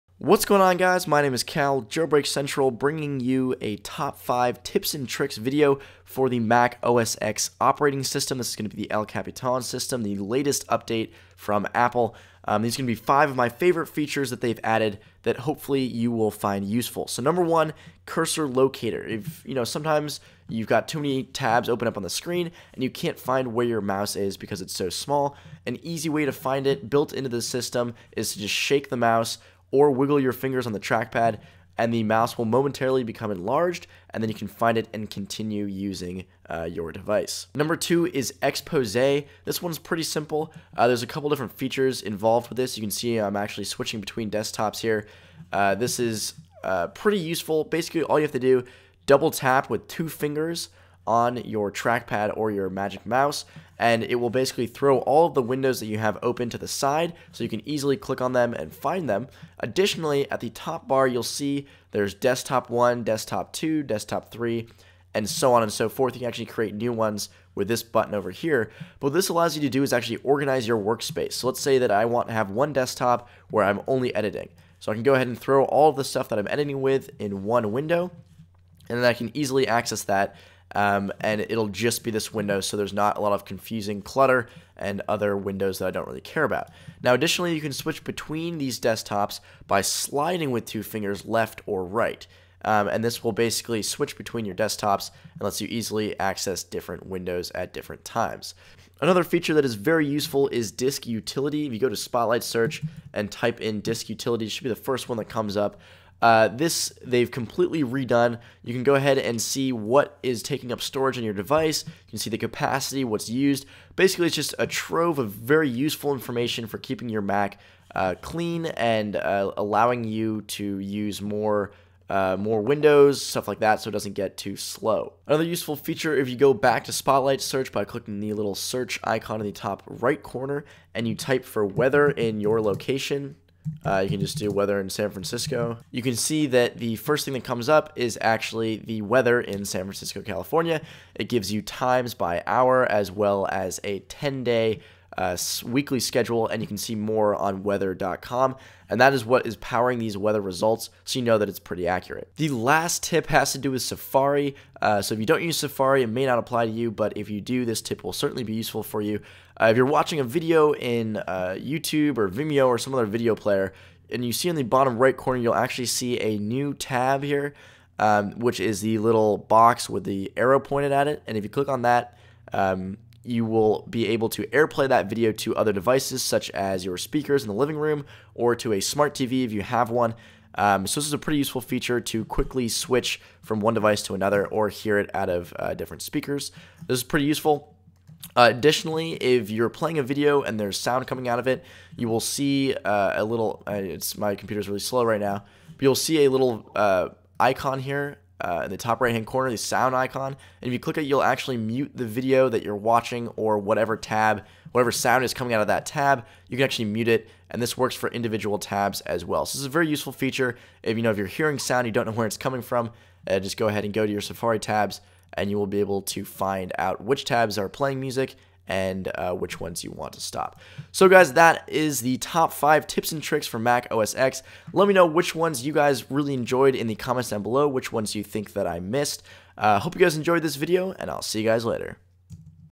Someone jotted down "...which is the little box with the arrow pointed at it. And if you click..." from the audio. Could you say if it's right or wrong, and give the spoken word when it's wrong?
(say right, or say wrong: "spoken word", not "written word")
right.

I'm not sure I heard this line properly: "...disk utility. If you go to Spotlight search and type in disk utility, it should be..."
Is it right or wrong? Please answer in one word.
right.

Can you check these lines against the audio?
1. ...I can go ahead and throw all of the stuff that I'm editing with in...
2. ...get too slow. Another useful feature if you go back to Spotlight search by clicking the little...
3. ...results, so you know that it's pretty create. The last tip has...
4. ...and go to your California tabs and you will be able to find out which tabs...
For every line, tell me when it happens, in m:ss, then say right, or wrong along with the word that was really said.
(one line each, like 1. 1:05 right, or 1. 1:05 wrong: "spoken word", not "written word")
1. 1:14 right
2. 2:04 right
3. 2:30 wrong: "accurate", not "create"
4. 3:33 wrong: "Safari", not "California".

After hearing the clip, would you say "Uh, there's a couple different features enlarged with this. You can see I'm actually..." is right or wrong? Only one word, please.
wrong.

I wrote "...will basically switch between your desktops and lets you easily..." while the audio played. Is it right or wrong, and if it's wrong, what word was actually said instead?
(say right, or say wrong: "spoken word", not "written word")
right.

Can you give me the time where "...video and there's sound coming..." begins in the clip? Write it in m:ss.
3:10.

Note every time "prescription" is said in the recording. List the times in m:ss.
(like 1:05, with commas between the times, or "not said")
not said.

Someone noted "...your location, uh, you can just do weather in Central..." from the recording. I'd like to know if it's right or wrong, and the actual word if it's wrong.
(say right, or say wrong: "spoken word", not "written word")
wrong: "San", not "Central".